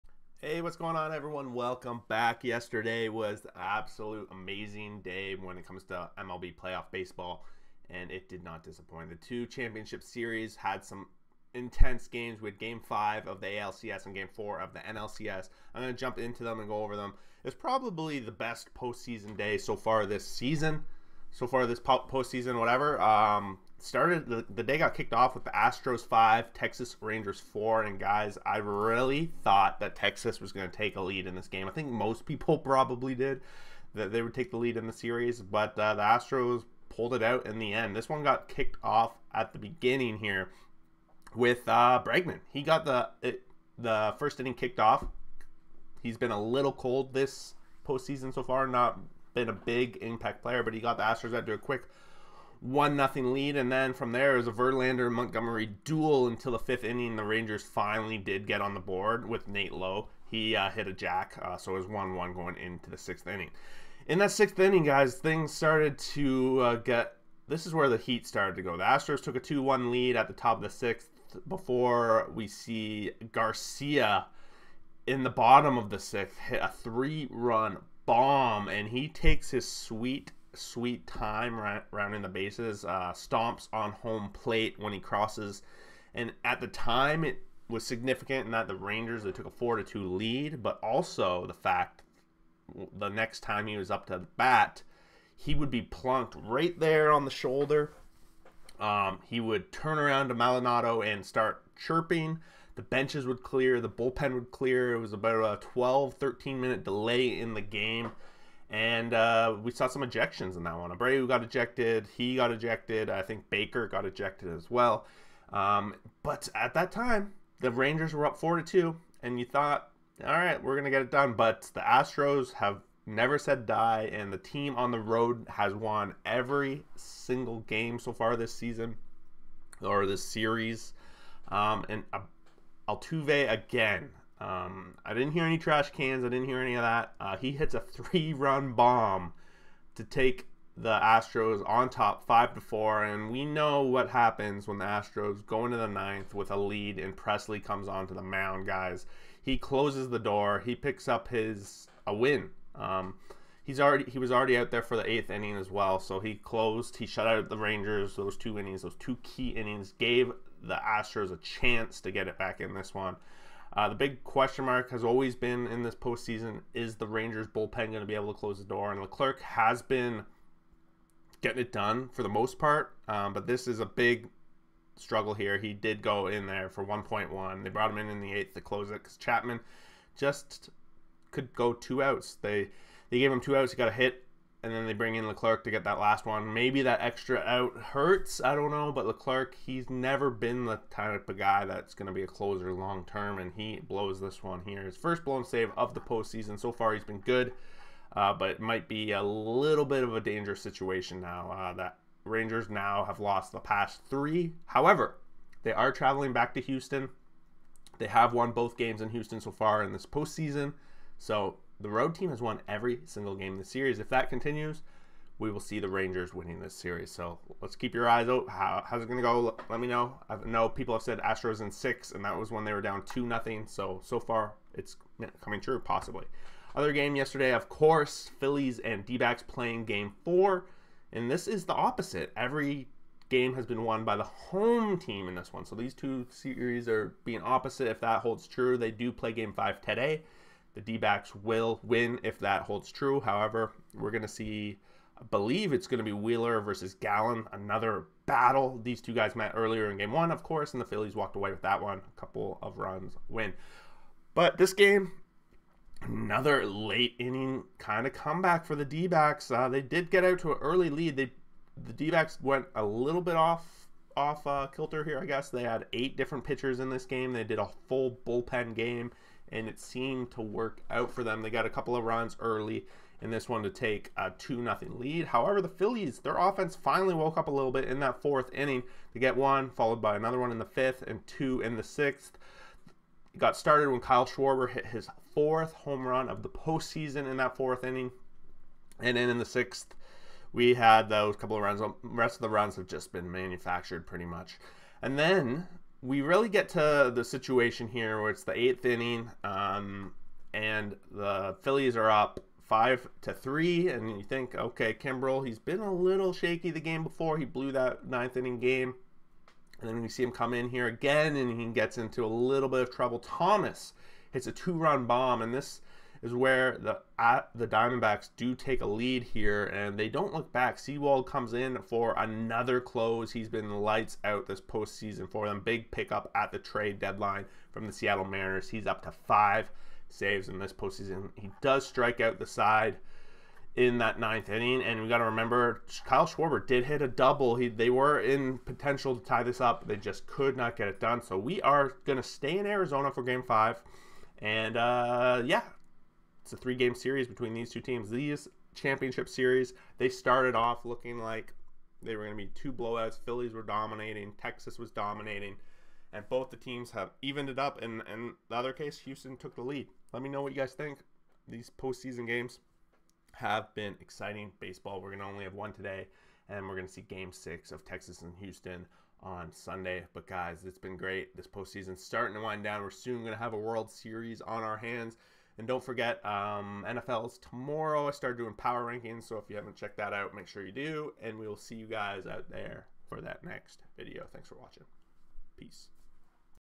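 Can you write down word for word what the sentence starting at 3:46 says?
Other game yesterday, of course, Phillies and d playing game four, and this is the opposite.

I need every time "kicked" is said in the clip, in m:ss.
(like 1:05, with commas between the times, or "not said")
0:24, 0:38, 0:44.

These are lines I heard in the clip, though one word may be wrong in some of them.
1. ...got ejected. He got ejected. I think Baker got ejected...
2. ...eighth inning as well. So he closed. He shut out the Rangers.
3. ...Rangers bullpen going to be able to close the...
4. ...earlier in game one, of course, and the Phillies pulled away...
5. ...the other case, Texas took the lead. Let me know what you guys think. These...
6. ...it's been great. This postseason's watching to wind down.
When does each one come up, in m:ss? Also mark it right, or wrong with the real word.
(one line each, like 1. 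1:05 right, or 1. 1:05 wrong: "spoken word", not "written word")
1. 1:51 right
2. 2:35 right
3. 2:47 right
4. 4:09 wrong: "walked", not "pulled"
5. 5:58 wrong: "Houston", not "Texas"
6. 6:10 wrong: "starting", not "watching".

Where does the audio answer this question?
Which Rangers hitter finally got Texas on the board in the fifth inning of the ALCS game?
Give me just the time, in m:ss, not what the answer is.
0:59.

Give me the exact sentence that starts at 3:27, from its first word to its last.
They have won both games in Houston so far in this postseason.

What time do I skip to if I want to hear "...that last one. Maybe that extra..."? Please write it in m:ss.
3:05.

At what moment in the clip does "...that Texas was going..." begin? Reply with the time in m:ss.
0:29.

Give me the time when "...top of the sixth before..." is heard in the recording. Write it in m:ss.
1:10.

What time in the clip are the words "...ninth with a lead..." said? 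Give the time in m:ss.
2:25.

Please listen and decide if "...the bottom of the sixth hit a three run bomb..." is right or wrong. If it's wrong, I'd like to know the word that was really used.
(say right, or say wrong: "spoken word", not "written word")
right.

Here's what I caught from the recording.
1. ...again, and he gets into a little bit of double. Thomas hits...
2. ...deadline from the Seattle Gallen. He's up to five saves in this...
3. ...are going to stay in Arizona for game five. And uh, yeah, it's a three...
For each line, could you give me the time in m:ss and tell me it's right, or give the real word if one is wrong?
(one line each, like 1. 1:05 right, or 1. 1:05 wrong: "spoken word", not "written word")
1. 5:10 wrong: "trouble", not "double"
2. 5:26 wrong: "Mariners", not "Gallen"
3. 5:41 right.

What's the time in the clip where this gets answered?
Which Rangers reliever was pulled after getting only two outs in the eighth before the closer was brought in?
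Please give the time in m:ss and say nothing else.
2:59.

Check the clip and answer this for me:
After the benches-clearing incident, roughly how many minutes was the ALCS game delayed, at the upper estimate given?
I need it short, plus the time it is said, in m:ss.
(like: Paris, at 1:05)
13, at 1:46.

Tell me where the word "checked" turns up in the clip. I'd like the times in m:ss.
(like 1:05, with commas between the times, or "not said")
6:19.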